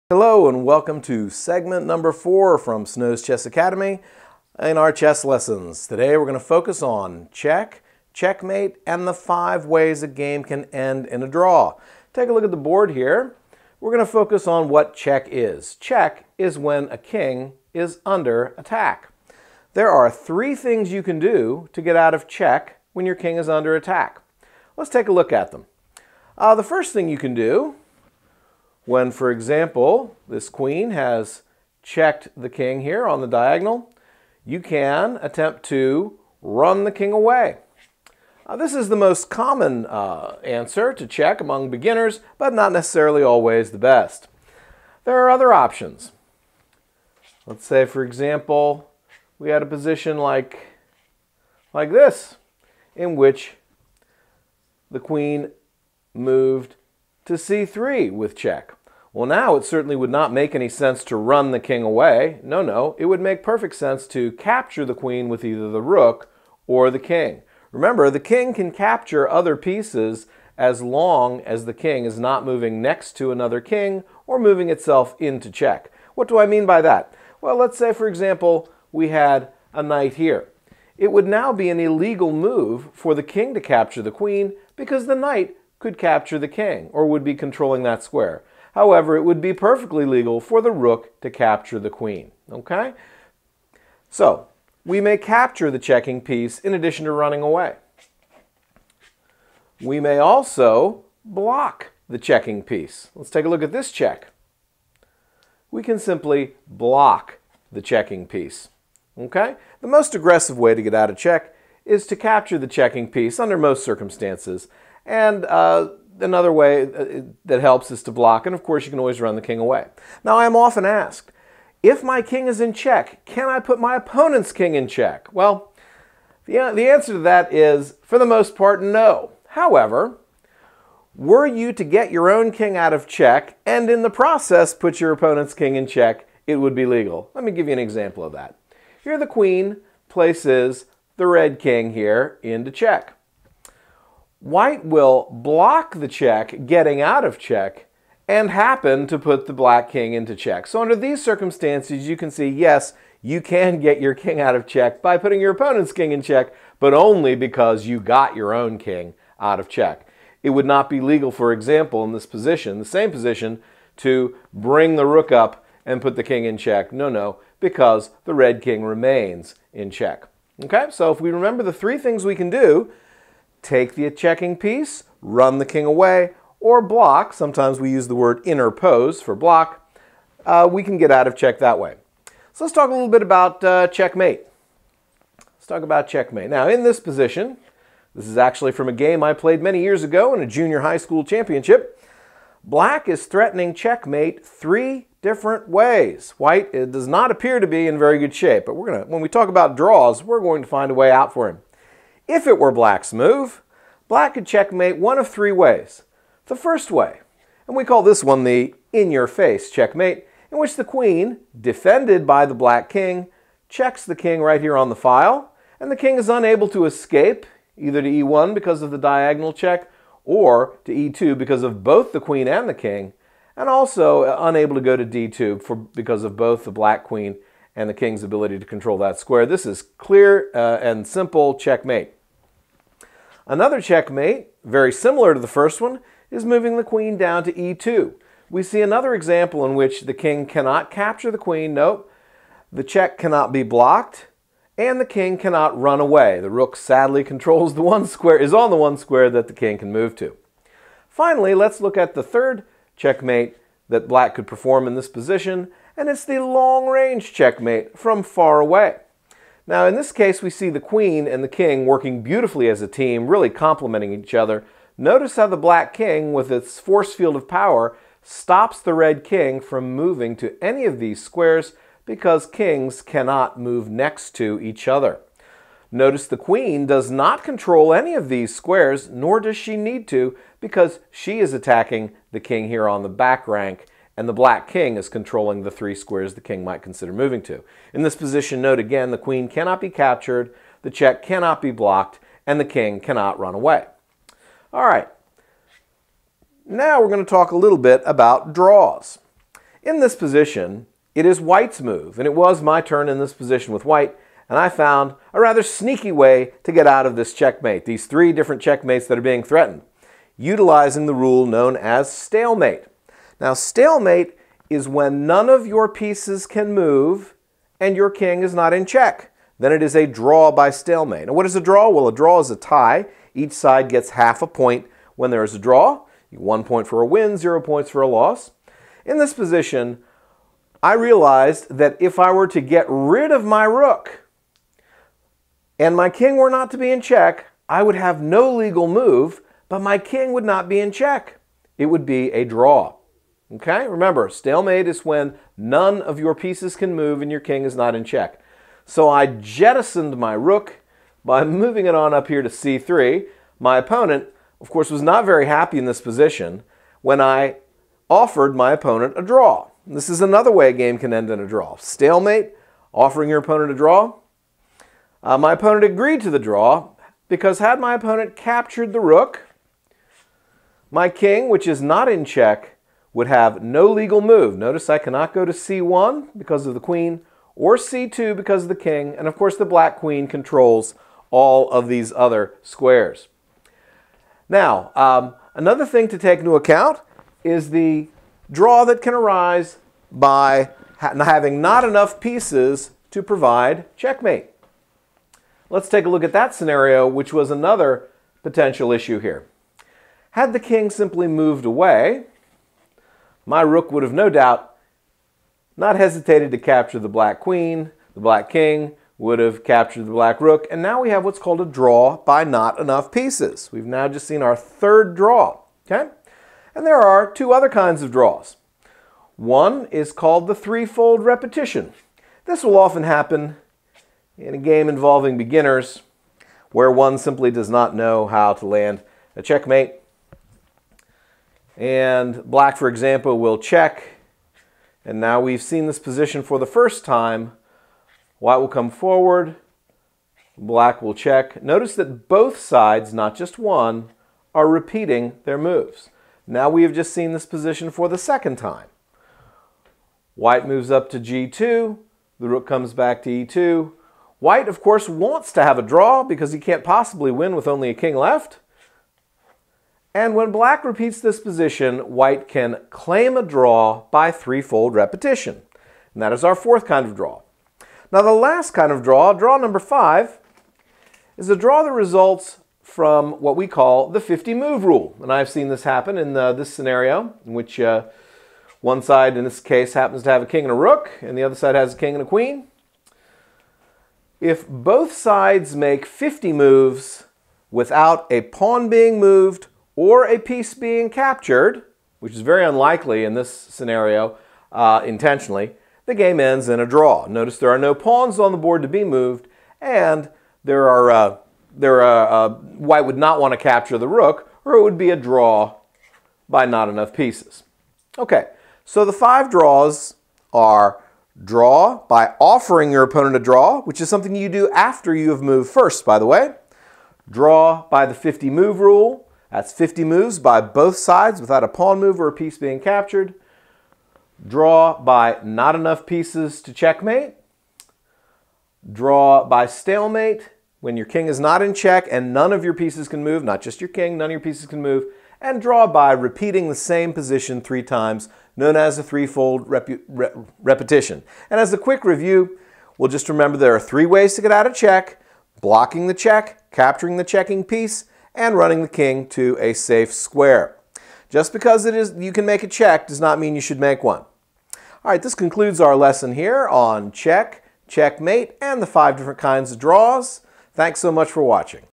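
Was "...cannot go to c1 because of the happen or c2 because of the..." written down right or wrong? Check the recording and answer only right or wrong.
wrong.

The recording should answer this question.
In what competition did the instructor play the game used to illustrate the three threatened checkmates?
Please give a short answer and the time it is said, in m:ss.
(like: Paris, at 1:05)
junior high school championship, at 3:10.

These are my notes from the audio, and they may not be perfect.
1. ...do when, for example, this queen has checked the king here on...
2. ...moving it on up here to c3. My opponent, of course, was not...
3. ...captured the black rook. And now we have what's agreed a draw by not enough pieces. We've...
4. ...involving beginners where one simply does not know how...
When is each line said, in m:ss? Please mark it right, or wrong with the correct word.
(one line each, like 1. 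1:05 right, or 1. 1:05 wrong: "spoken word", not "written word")
1. 0:27 right
2. 5:51 right
3. 6:49 wrong: "called", not "agreed"
4. 7:04 right.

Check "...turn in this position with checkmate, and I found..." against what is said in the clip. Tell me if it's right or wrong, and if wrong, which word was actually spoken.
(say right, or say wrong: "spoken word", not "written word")
wrong: "white", not "checkmate".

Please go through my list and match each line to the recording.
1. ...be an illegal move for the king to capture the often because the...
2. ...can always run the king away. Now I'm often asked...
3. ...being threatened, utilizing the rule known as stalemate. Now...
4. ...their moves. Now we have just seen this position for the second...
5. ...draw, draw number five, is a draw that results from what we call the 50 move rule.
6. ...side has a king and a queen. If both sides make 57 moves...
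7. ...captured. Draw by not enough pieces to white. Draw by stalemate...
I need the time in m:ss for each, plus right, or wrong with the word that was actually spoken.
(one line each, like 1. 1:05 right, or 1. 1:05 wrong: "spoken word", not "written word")
1. 1:21 wrong: "queen", not "often"
2. 1:58 right
3. 5:09 right
4. 7:25 right
5. 7:49 right
6. 8:01 wrong: "50", not "57"
7. 8:42 wrong: "checkmate", not "white".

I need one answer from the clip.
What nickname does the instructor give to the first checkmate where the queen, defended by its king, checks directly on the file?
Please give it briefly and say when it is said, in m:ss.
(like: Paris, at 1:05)
in-your-face checkmate, at 3:28.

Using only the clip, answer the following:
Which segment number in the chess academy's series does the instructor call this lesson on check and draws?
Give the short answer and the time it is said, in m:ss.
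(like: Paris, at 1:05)
4, at 0:01.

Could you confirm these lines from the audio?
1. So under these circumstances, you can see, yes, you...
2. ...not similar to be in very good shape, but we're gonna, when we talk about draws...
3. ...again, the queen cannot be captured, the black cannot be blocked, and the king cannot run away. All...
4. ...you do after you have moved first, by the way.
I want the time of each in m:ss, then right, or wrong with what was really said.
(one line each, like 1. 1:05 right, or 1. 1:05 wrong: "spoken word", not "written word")
1. 2:30 right
2. 3:17 wrong: "appear", not "similar"
3. 4:48 wrong: "check", not "black"
4. 8:34 right.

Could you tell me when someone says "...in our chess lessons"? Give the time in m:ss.
0:04.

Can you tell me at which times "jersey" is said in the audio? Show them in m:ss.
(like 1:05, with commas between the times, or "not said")
not said.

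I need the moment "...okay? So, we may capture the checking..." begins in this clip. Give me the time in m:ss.
1:32.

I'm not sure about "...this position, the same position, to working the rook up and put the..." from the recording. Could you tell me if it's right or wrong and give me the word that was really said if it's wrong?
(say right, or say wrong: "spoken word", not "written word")
wrong: "bring", not "working".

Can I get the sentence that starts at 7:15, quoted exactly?
And now we've seen this position for the first time.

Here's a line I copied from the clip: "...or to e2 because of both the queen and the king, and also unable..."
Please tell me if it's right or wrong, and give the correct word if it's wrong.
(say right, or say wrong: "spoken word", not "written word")
right.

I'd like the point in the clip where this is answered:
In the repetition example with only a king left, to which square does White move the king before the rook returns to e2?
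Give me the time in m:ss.
7:31.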